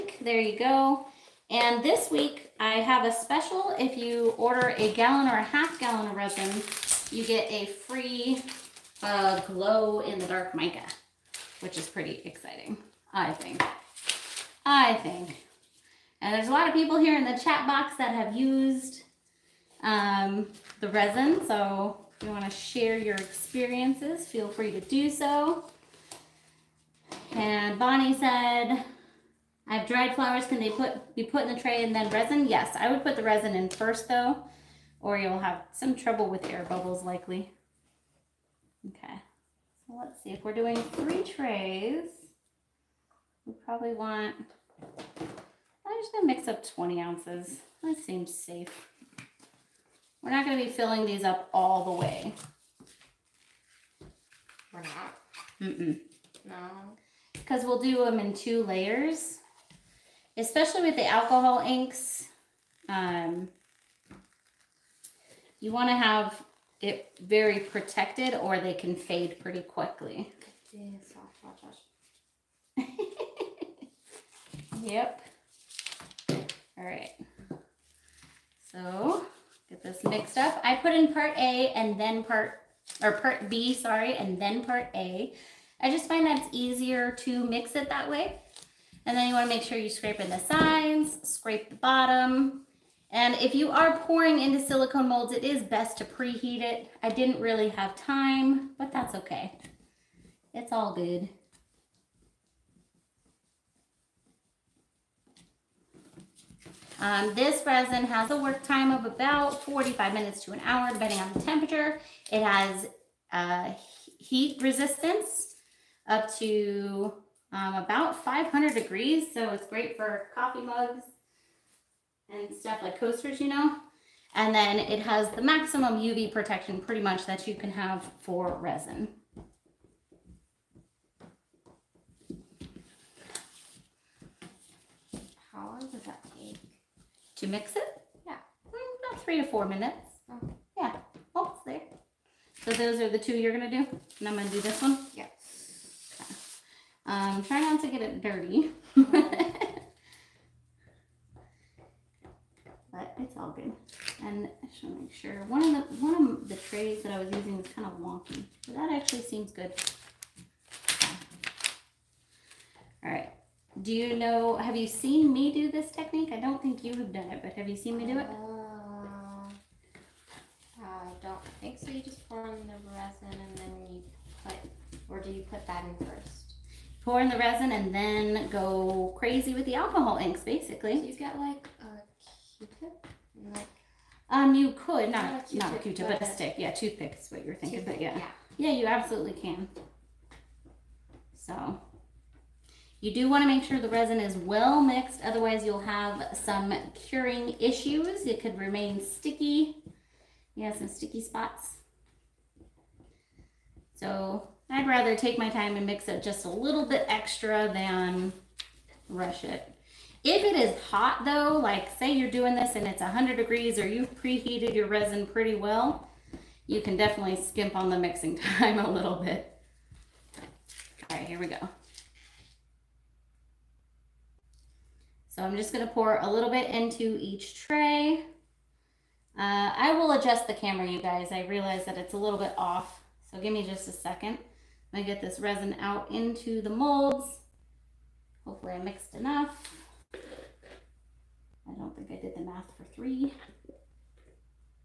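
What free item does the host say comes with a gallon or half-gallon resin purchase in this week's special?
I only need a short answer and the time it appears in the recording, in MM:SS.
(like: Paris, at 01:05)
glow in the dark mica, at 00:09.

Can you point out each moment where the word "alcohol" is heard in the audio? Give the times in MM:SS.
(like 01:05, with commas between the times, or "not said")
01:01, 02:59.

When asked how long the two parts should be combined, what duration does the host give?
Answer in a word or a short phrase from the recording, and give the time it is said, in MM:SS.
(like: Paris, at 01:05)
3 to 4 minutes, at 02:19.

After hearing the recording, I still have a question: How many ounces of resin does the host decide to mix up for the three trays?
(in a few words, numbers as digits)
20.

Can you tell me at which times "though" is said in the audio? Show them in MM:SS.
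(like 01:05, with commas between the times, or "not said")
00:34, 03:31.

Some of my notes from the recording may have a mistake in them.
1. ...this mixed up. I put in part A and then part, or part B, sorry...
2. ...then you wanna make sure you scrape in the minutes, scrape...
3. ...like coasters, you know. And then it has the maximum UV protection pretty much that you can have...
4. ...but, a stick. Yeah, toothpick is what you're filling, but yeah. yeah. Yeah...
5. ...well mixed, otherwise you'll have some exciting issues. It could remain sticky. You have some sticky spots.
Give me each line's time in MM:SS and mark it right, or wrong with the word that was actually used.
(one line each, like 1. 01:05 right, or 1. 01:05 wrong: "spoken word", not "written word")
1. 01:19 right
2. 01:29 wrong: "sides", not "minutes"
3. 02:02 right
4. 03:06 wrong: "thinking", not "filling"
5. 03:14 wrong: "curing", not "exciting".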